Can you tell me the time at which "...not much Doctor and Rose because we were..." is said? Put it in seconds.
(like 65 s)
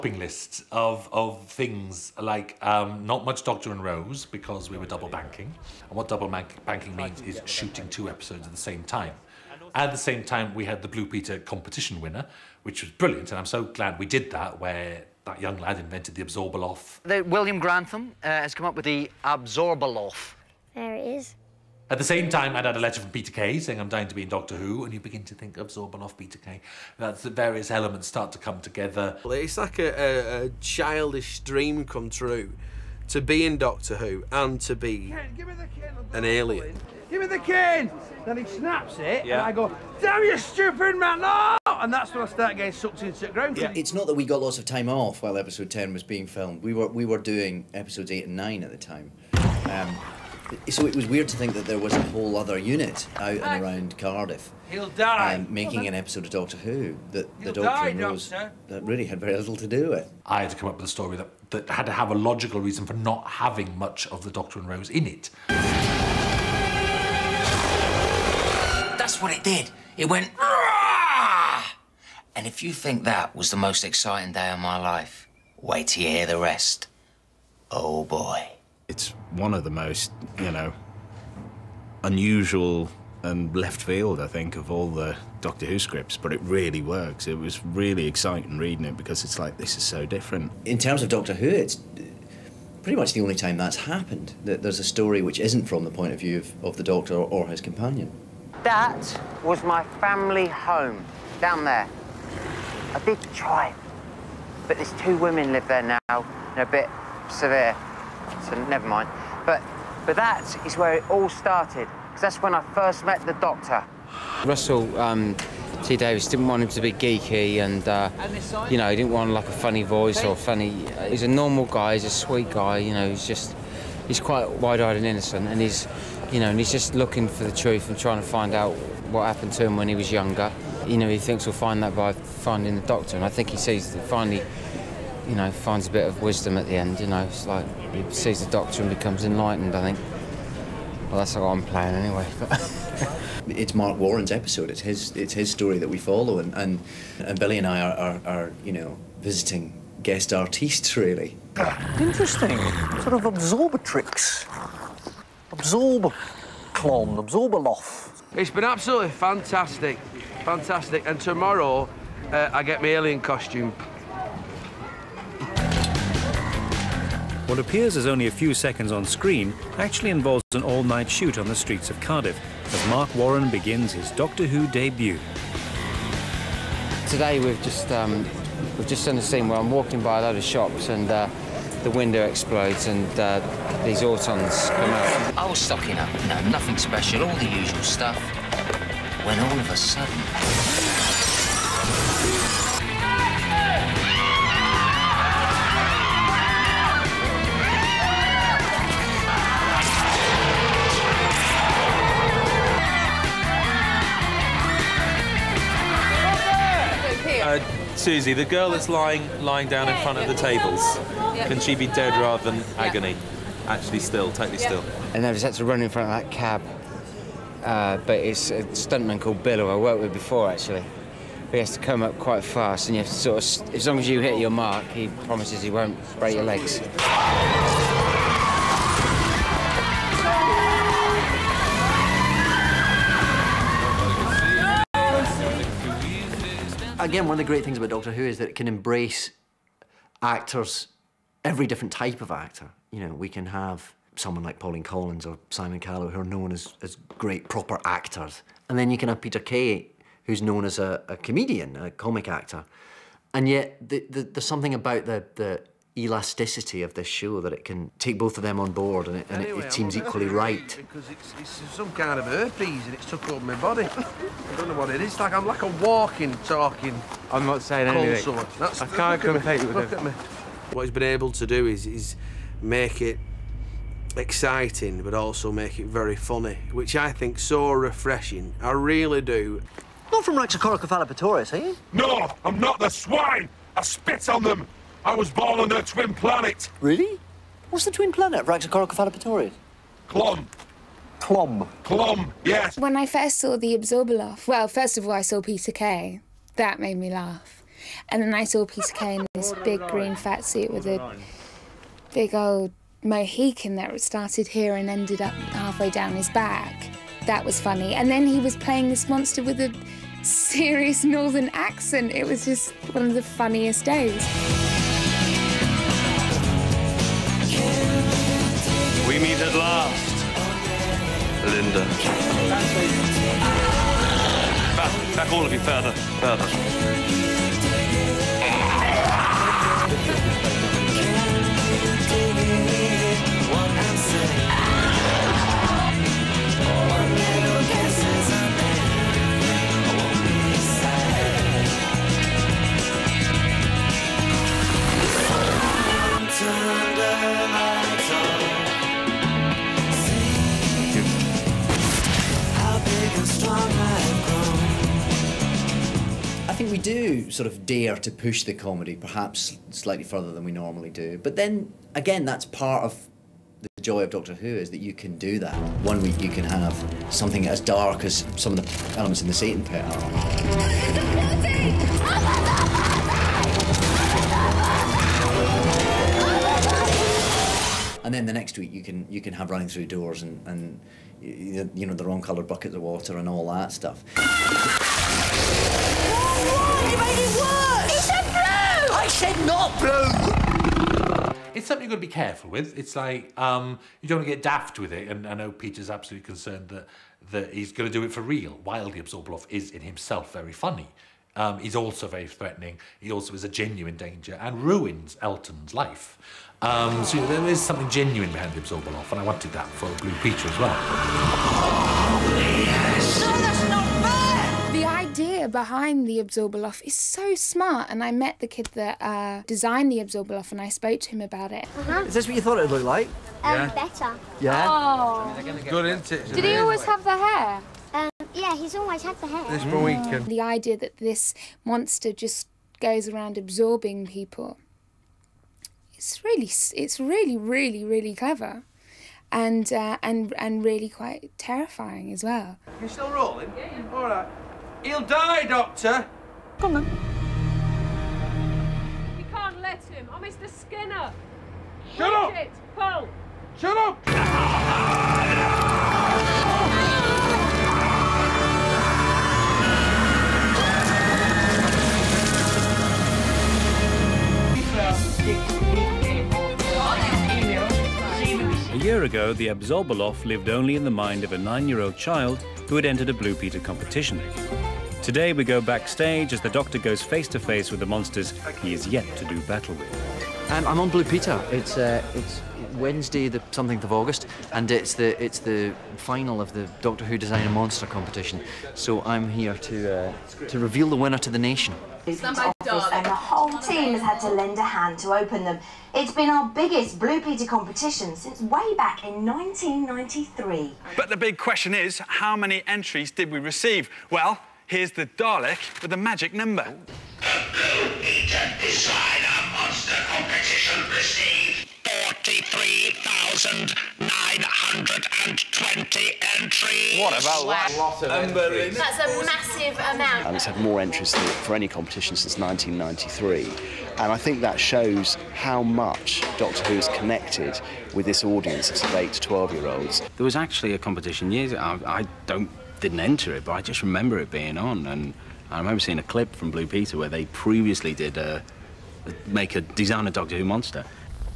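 3 s.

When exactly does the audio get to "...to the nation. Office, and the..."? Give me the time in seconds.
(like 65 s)
491 s.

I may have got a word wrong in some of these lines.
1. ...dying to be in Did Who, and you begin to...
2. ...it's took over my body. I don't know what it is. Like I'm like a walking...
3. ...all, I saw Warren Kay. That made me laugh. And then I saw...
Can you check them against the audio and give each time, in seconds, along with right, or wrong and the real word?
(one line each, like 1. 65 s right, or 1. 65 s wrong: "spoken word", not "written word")
1. 23 s wrong: "Doctor", not "Did"
2. 262 s right
3. 295 s wrong: "Peter", not "Warren".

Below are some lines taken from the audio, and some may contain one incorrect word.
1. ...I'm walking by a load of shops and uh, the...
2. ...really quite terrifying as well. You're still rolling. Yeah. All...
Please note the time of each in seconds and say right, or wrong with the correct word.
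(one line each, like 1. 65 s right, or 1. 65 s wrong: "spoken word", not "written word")
1. 179 s right
2. 440 s right.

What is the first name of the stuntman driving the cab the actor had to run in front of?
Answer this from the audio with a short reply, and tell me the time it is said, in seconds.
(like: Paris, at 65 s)
Bill, at 219 s.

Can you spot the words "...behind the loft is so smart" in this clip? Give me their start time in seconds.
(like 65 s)
415 s.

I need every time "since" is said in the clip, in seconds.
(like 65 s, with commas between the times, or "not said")
498 s, 522 s.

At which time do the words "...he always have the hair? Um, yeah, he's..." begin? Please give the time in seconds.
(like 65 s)
426 s.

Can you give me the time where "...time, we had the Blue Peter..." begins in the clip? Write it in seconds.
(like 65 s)
10 s.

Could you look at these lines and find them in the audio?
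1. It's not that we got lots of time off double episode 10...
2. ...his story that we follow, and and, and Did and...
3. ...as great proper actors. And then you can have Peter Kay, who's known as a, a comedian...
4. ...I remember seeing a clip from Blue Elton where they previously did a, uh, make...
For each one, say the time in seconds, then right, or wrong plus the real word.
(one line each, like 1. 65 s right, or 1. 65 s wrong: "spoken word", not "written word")
1. 43 s wrong: "while", not "double"
2. 145 s wrong: "Billie", not "Did"
3. 246 s right
4. 535 s wrong: "Peter", not "Elton".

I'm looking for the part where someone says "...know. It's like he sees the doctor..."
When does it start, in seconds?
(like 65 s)
137 s.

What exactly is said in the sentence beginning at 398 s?
Wildly Absorbaloff is in himself very funny.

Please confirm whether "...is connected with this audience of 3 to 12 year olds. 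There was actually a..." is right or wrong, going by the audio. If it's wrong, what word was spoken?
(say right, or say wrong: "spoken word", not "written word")
wrong: "8", not "3".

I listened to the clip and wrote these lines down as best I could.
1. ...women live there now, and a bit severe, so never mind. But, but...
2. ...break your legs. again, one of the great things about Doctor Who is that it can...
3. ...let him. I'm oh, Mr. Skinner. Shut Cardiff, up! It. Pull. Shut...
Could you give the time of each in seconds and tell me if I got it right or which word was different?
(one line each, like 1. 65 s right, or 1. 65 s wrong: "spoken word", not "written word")
1. 105 s right
2. 226 s right
3. 449 s wrong: "Bridget", not "Cardiff".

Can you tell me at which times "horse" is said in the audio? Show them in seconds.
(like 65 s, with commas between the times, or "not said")
not said.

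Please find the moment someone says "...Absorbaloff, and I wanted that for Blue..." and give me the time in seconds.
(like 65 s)
408 s.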